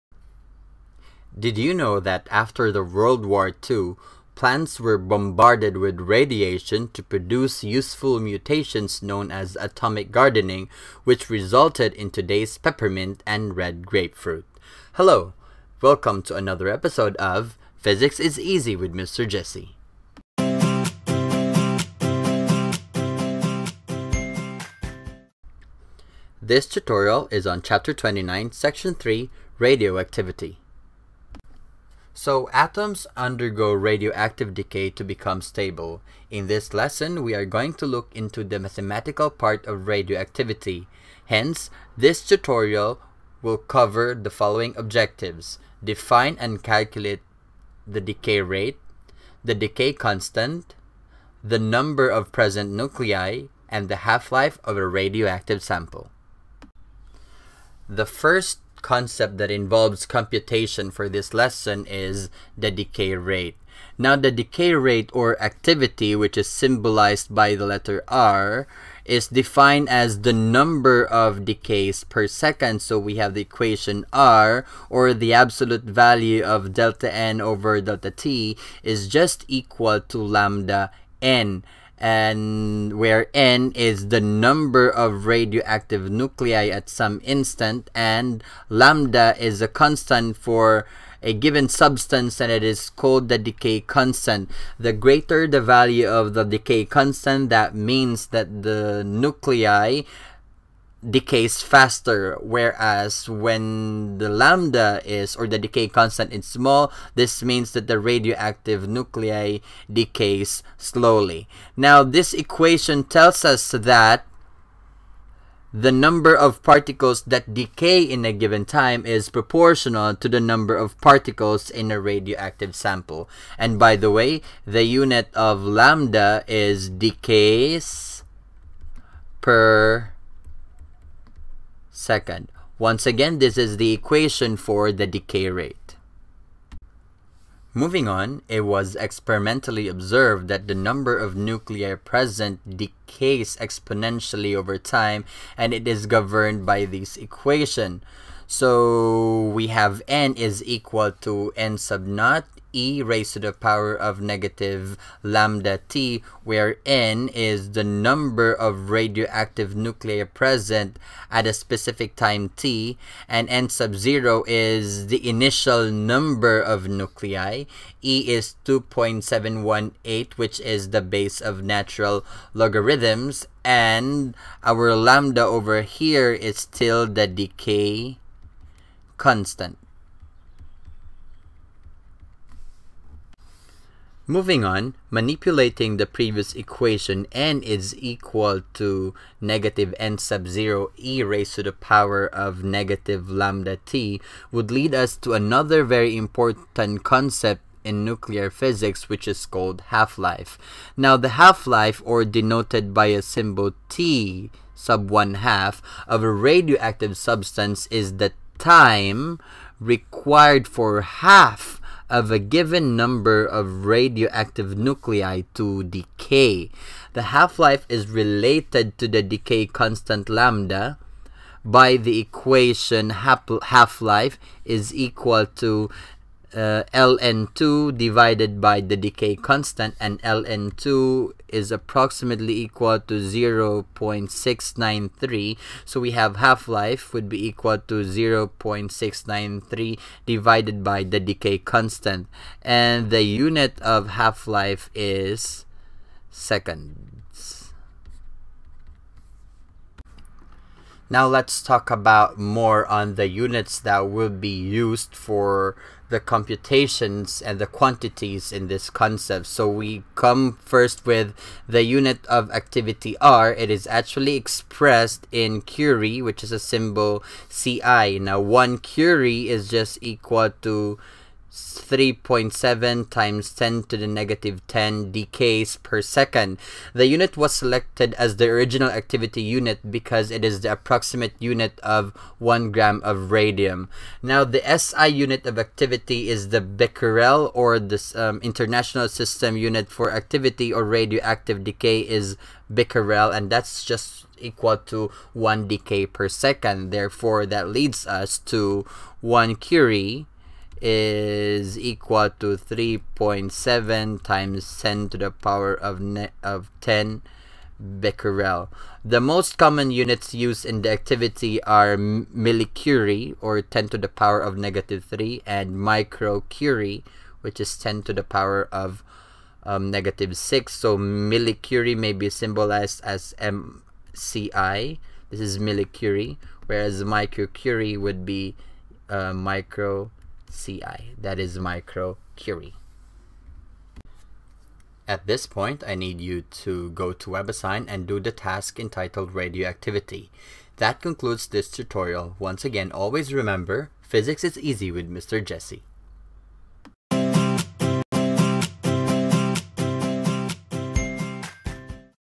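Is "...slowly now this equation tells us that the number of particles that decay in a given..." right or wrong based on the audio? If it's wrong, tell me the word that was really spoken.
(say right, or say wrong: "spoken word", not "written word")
right.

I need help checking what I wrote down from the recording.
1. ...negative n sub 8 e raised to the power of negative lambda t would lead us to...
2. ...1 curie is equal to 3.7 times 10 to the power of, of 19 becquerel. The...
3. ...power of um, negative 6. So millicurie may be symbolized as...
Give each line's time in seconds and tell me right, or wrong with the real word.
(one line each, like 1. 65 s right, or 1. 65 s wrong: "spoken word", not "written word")
1. 189 s wrong: "0", not "8"
2. 299 s wrong: "10", not "19"
3. 318 s right.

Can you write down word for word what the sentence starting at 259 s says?
So we come first with the unit of activity R.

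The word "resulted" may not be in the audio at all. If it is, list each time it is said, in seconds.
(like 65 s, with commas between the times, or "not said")
11 s.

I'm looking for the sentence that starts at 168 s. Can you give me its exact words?
e is 2.718, which is the base of natural logarithms, and our lambda over here is still the decay constant.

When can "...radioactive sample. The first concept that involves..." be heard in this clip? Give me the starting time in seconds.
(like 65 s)
54 s.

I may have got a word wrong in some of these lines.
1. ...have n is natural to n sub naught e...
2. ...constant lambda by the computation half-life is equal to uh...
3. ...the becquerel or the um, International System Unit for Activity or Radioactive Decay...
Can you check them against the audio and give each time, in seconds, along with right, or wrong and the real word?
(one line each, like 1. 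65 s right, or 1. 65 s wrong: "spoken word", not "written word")
1. 149 s wrong: "equal", not "natural"
2. 219 s wrong: "equation", not "computation"
3. 286 s right.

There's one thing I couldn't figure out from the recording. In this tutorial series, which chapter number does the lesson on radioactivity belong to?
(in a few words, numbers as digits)
29.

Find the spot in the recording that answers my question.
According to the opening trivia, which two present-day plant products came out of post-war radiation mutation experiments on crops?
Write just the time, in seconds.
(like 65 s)
12 s.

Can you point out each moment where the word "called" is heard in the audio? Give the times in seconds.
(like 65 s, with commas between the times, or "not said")
92 s, 199 s.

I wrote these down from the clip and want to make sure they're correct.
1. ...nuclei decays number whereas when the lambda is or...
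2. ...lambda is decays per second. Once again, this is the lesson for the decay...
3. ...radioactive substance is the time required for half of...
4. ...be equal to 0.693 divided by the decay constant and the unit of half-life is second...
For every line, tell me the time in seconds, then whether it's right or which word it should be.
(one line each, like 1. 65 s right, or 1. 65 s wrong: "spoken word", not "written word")
1. 99 s wrong: "faster", not "number"
2. 125 s wrong: "equation", not "lesson"
3. 206 s right
4. 237 s right.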